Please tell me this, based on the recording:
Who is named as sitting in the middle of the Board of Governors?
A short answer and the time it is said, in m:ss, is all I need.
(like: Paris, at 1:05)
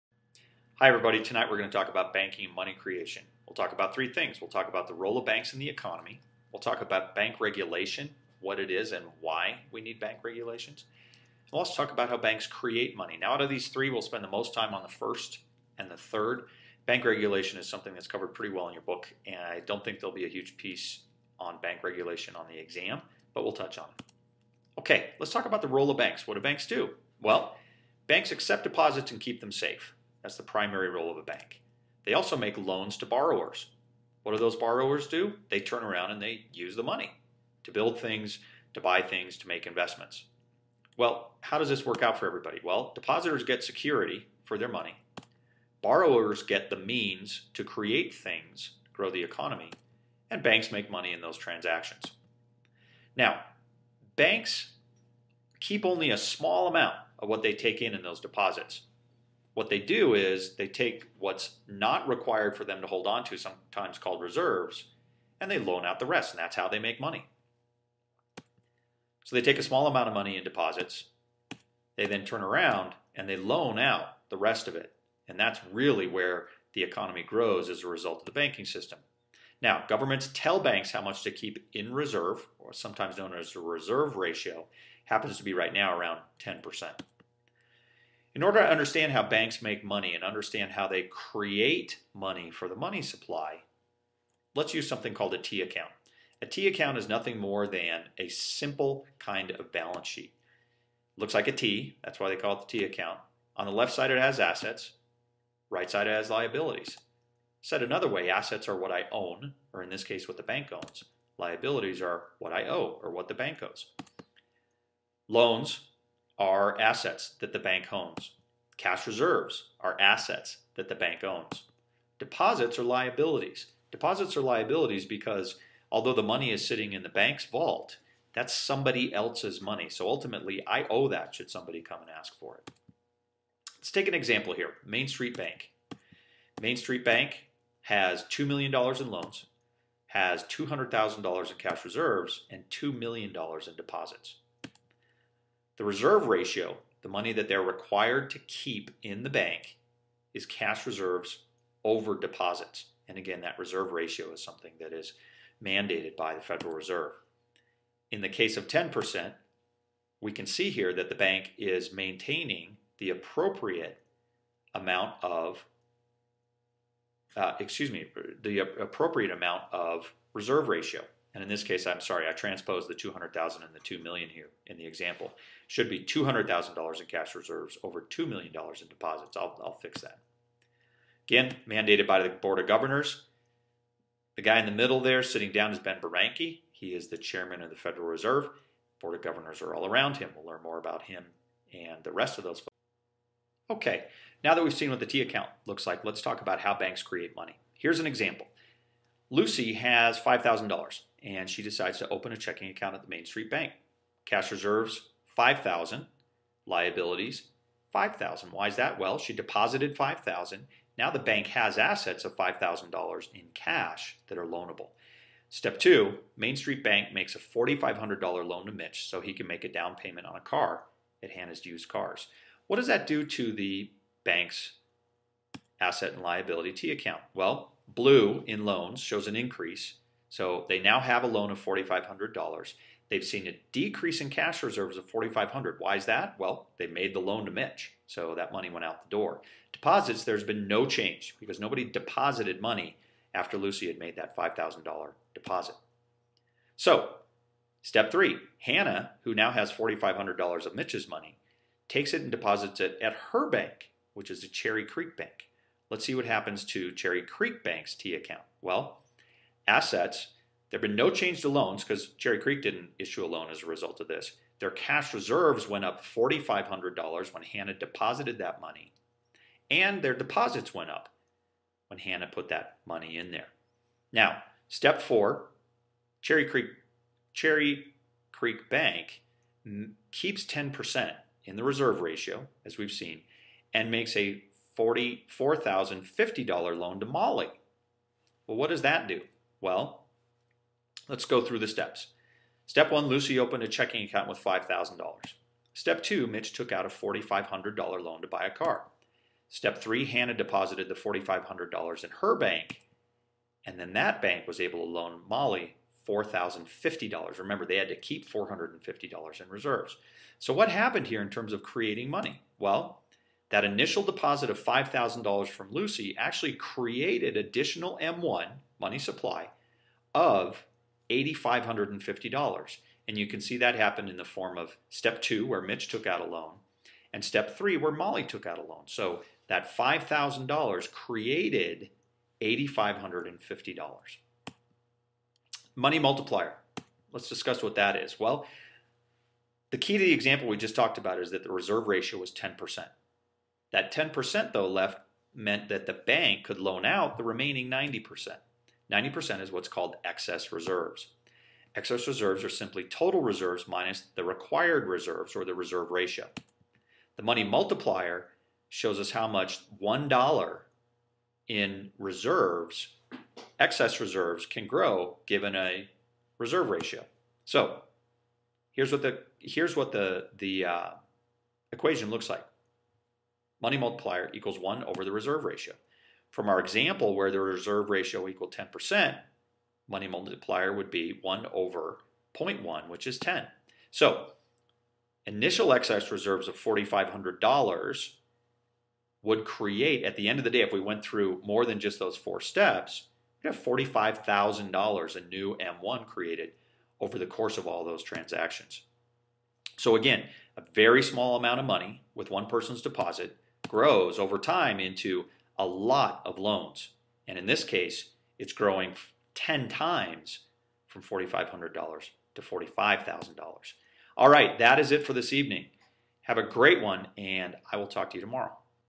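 Ben Bernanke, at 3:05.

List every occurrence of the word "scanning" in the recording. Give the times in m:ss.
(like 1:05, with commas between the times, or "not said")
not said.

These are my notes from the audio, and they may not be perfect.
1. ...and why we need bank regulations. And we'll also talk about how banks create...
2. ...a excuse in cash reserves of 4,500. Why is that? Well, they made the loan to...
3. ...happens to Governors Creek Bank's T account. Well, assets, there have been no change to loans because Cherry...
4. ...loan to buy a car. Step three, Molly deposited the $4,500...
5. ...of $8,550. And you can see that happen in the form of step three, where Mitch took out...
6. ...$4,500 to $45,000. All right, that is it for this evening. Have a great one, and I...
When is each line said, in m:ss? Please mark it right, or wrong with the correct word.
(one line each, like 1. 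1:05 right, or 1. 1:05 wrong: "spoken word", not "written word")
1. 0:08 right
2. 3:53 wrong: "decrease", not "excuse"
3. 4:16 wrong: "Cherry", not "Governors"
4. 4:57 wrong: "Hannah", not "Molly"
5. 5:20 wrong: "two", not "three"
6. 6:51 right.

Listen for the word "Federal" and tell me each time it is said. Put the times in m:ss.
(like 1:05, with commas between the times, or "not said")
2:36, 3:07.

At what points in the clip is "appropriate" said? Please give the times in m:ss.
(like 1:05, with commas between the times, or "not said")
2:43, 2:48.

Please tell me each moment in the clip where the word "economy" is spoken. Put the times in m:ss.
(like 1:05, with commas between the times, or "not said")
0:05, 0:49, 1:16.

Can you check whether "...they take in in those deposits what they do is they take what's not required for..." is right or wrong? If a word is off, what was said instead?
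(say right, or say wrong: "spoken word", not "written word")
right.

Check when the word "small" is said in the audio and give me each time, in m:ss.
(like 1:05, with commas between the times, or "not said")
0:56, 1:09, 6:41.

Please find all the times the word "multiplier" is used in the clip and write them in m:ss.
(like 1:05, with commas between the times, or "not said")
5:35, 5:57, 6:13, 6:20.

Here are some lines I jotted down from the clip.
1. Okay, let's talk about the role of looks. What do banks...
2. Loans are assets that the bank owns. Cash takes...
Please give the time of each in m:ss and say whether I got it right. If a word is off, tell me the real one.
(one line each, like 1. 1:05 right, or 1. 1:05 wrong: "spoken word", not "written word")
1. 0:24 wrong: "banks", not "looks"
2. 1:55 wrong: "reserves", not "takes".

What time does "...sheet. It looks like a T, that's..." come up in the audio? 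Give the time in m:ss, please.
1:40.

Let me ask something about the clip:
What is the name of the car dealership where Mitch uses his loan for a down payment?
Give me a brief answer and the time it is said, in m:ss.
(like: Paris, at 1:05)
Hannah's Used Cars, at 3:41.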